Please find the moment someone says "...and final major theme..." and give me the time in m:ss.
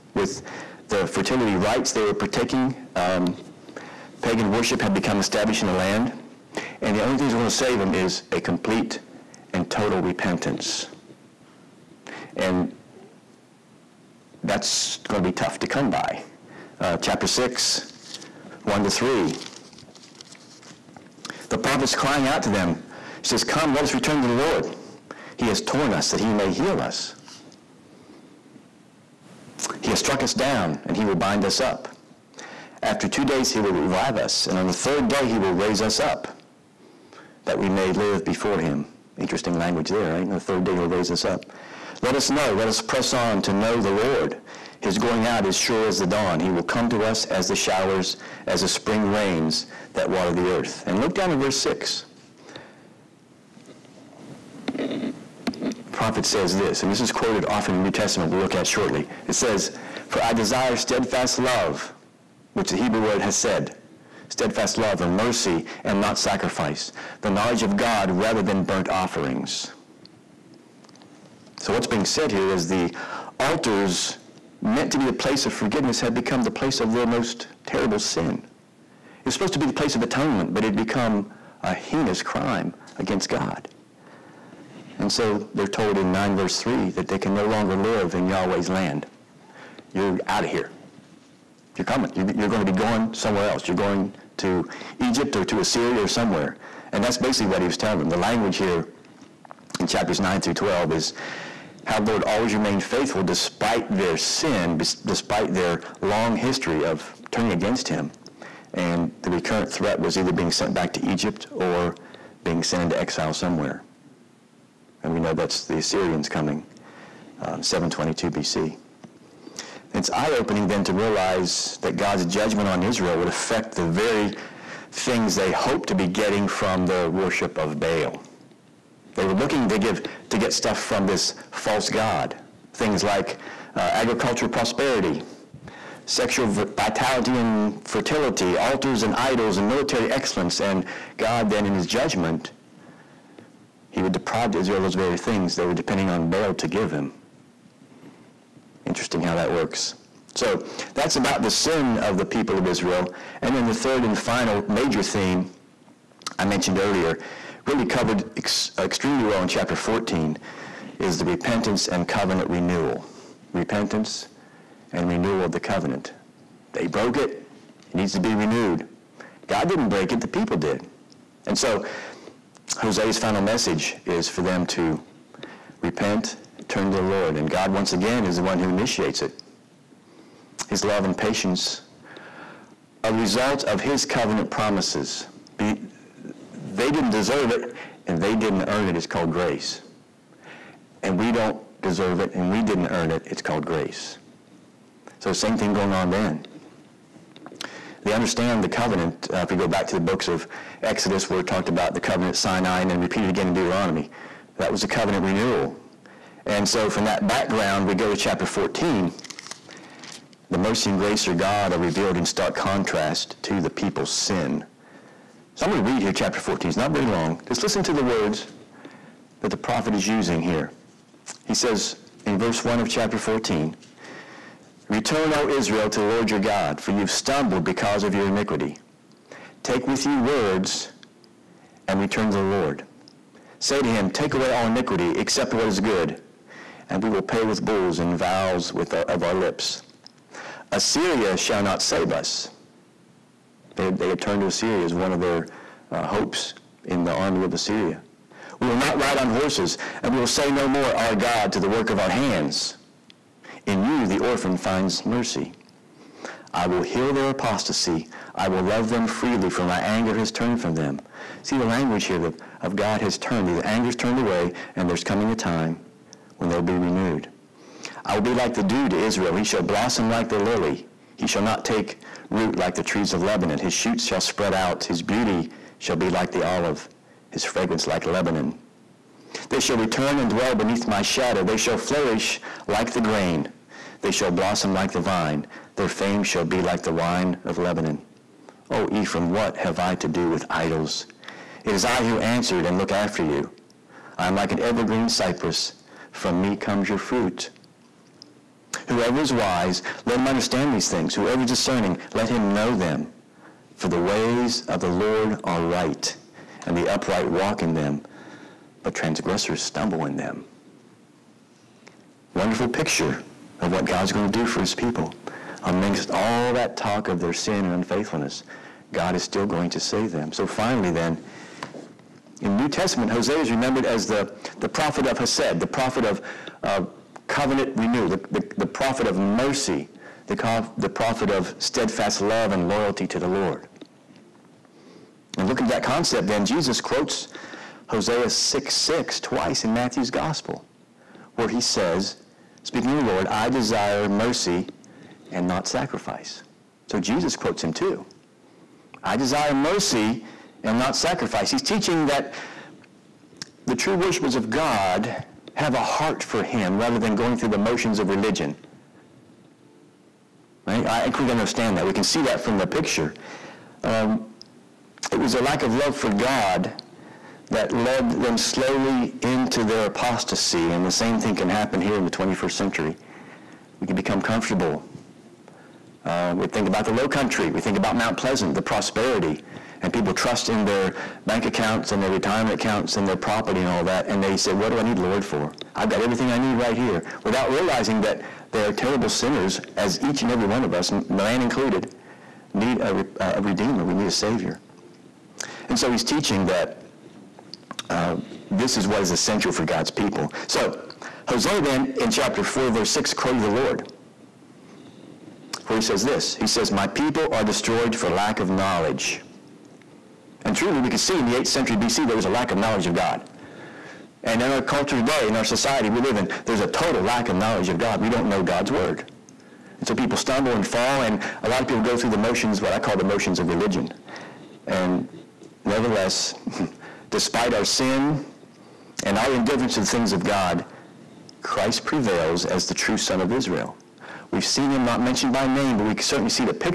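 2:34.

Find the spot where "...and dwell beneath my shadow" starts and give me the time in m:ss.
4:40.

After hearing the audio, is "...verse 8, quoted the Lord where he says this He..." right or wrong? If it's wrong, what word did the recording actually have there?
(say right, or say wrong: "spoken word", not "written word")
wrong: "6", not "8".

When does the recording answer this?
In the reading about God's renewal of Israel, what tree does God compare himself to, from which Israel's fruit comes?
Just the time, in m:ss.
4:54.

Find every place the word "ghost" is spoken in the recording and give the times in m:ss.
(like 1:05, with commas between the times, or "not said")
not said.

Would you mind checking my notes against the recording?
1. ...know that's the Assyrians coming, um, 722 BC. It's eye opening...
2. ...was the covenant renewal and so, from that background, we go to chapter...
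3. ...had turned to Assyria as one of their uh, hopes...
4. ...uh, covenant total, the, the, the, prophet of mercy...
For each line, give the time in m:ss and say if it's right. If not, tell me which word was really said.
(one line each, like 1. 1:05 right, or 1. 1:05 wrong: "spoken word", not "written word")
1. 1:55 right
2. 3:24 right
3. 4:04 right
4. 5:26 wrong: "renewal", not "total".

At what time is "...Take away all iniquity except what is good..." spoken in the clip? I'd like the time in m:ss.
3:54.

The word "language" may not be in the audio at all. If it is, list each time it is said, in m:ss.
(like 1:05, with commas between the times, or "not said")
0:39, 1:38, 4:21.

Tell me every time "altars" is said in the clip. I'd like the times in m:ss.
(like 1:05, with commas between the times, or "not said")
1:13, 2:18.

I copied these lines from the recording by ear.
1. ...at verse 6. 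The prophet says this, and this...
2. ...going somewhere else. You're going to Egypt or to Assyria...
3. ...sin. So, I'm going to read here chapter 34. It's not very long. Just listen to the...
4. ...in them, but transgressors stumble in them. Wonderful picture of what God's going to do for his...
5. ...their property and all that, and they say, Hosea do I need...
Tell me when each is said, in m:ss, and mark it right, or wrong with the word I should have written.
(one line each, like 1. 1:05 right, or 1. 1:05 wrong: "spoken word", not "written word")
1. 0:51 right
2. 1:32 right
3. 3:34 wrong: "14", not "34"
4. 5:07 right
5. 6:23 wrong: "What", not "Hosea".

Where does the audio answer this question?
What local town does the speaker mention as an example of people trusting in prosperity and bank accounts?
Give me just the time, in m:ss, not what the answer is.
6:17.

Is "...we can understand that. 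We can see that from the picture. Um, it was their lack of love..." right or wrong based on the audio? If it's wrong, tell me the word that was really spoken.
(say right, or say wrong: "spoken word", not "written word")
right.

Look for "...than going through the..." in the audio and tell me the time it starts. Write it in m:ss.
5:56.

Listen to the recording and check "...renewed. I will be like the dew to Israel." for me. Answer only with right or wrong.
right.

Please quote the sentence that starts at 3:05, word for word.
Be, they didn't deserve it, and they didn't earn it.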